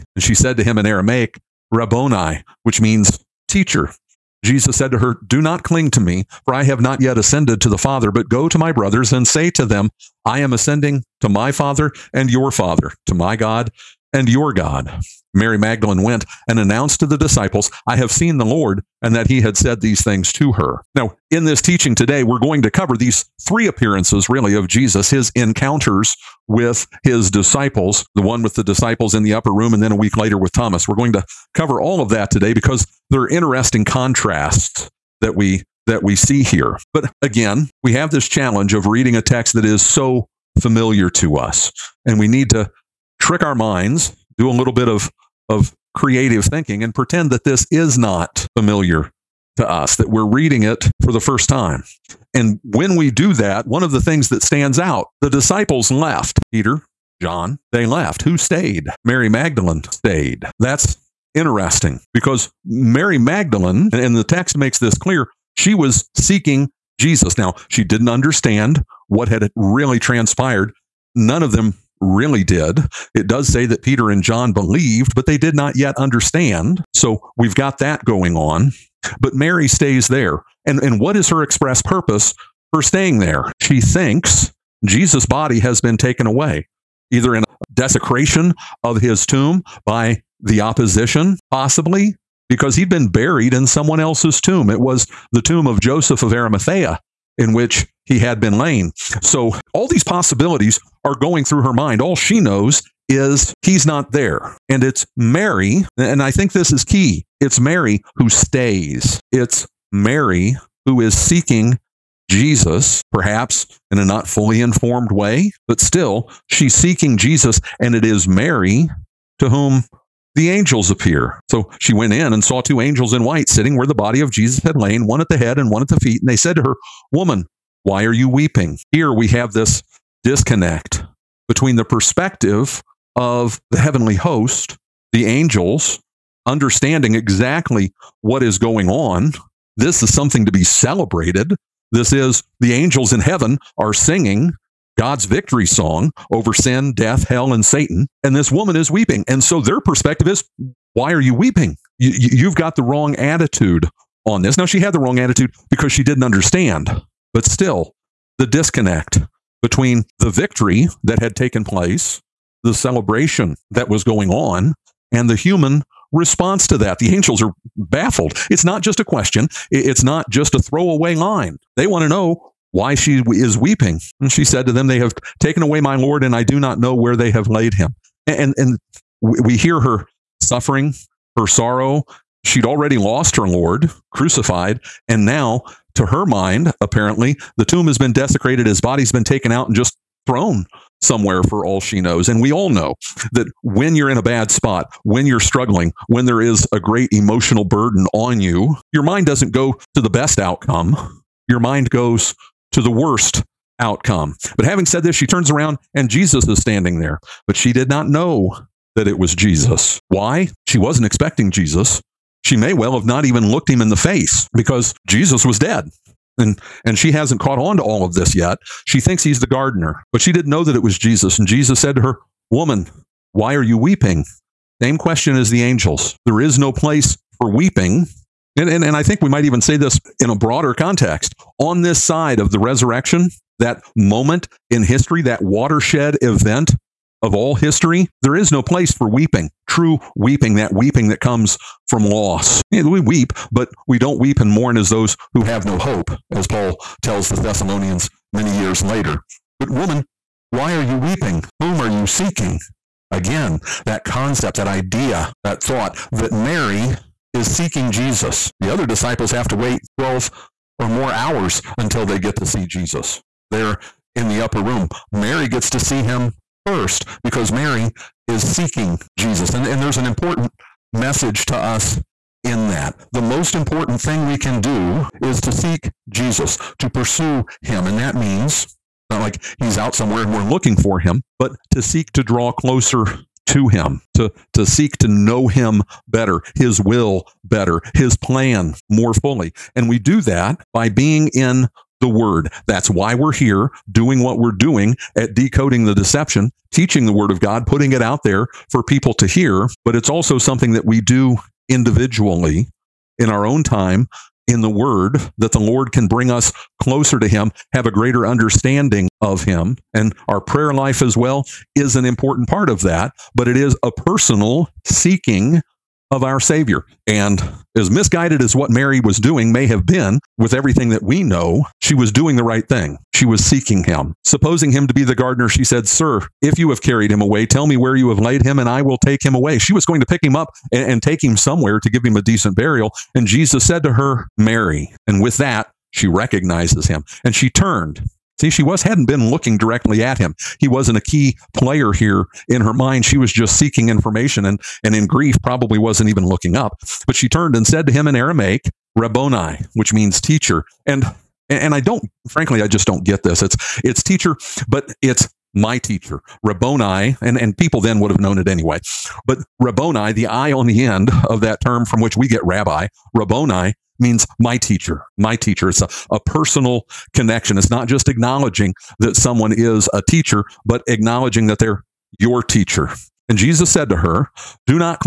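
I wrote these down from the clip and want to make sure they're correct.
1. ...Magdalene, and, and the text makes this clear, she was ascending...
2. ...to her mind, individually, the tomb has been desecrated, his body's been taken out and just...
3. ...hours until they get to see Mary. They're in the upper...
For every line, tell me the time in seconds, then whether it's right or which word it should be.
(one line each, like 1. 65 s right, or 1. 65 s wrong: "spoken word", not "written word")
1. 63 s wrong: "seeking", not "ascending"
2. 185 s wrong: "apparently", not "individually"
3. 261 s wrong: "Jesus", not "Mary".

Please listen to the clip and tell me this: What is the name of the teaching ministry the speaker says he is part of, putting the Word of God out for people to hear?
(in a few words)
Decoding the Deception.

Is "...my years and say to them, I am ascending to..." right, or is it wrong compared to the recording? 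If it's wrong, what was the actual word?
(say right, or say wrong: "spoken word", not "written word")
wrong: "brothers", not "years".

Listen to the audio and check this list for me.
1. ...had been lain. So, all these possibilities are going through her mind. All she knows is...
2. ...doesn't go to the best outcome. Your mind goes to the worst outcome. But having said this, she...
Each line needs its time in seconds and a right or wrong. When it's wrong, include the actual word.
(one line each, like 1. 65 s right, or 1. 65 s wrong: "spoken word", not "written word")
1. 98 s right
2. 199 s right.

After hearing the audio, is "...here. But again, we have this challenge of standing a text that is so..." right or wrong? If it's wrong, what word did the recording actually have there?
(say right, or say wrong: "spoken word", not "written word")
wrong: "reading", not "standing".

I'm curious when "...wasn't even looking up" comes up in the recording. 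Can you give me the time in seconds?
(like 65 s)
345 s.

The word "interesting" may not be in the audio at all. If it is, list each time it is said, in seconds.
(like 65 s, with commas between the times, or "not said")
33 s, 61 s.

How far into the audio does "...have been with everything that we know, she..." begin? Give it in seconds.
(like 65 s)
319 s.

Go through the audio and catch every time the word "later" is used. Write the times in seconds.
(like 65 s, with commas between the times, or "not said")
30 s, 248 s.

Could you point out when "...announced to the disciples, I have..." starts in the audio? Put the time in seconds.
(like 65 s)
16 s.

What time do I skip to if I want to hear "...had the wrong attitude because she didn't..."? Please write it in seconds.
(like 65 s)
154 s.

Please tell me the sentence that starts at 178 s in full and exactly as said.
And, and we hear her suffering, her sorrow.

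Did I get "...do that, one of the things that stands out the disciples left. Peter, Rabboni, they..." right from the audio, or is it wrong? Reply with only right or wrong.
wrong.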